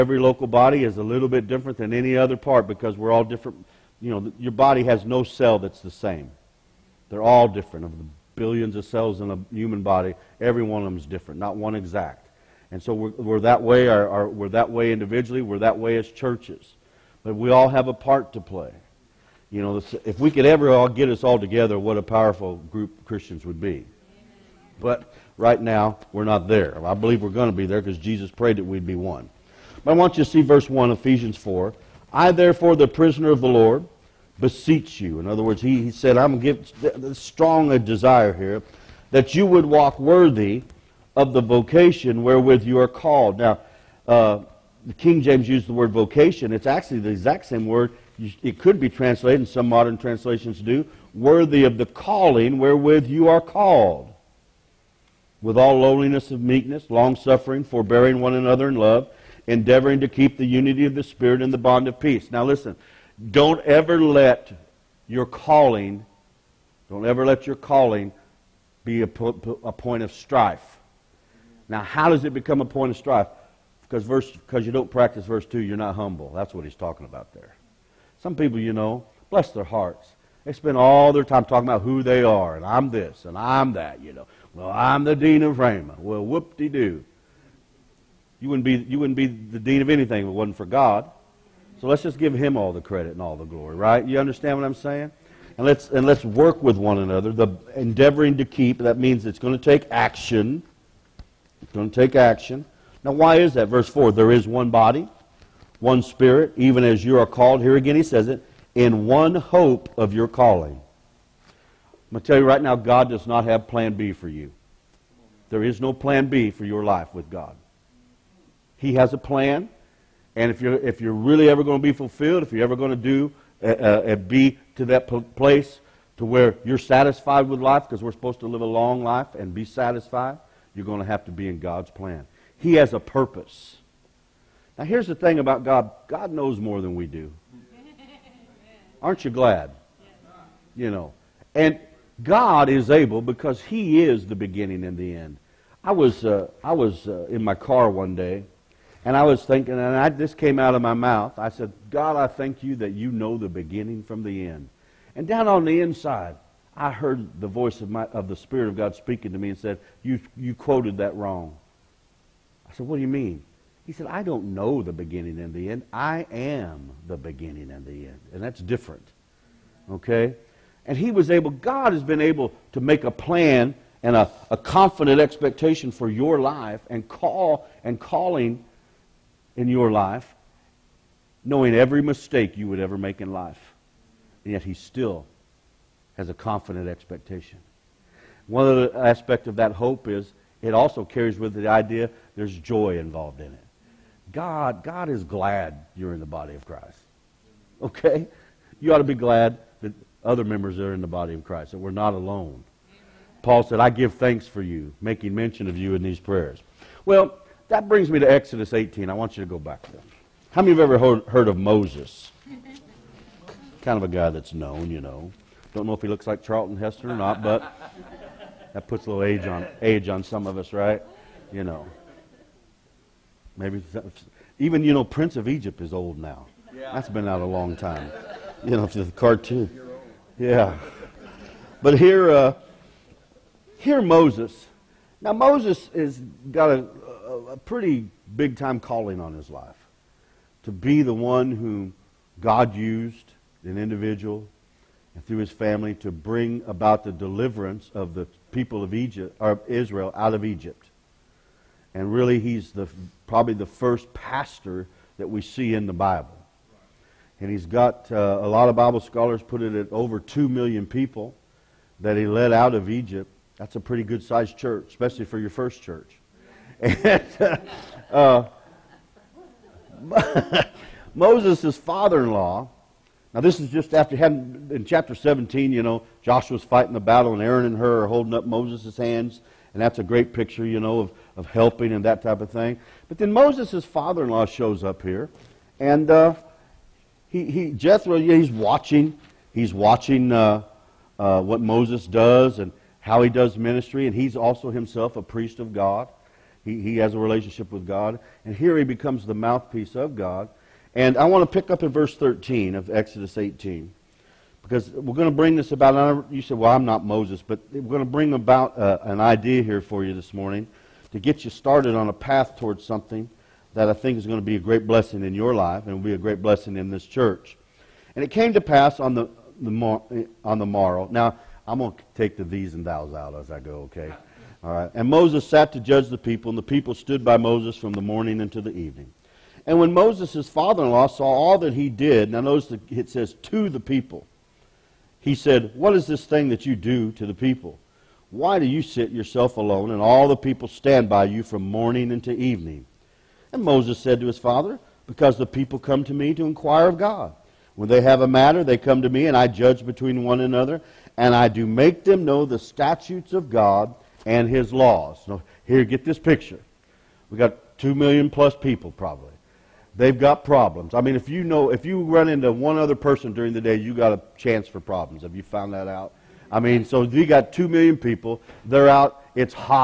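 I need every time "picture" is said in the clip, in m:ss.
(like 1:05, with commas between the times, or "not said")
4:40, 5:56.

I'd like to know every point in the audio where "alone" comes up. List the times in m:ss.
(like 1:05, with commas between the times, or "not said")
3:22, 5:39.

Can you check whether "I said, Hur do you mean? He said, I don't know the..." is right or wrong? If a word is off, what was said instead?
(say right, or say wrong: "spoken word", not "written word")
wrong: "What", not "Hur".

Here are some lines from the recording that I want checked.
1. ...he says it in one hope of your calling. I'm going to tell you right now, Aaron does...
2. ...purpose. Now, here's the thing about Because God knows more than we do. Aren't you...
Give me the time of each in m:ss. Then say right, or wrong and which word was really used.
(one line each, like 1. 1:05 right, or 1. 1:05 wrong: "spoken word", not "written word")
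1. 1:47 wrong: "God", not "Aaron"
2. 2:12 wrong: "God", not "Because".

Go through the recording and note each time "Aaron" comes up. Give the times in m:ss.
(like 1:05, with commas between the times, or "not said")
4:37.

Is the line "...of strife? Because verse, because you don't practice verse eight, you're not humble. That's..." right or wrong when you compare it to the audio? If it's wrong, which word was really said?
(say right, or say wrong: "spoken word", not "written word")
wrong: "two", not "eight".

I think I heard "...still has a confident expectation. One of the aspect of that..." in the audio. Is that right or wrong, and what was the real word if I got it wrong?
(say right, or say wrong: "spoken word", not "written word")
right.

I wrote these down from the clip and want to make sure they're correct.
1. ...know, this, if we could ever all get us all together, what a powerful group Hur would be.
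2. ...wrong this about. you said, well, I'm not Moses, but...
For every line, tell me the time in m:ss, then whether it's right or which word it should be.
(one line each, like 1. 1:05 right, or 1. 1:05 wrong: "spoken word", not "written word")
1. 0:19 wrong: "Christians", not "Hur"
2. 5:05 wrong: "bring", not "wrong".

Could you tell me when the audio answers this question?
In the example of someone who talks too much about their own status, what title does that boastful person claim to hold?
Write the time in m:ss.
1:25.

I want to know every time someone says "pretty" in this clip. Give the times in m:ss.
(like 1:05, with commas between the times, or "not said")
3:57, 4:23.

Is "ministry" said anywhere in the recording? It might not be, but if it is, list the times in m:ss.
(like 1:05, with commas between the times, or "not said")
4:53.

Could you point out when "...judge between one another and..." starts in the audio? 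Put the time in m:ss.
5:49.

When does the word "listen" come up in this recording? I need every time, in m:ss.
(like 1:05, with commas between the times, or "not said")
1:02.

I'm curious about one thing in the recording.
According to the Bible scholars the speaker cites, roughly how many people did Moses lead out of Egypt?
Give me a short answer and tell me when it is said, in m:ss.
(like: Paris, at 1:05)
over 2 million, at 4:19.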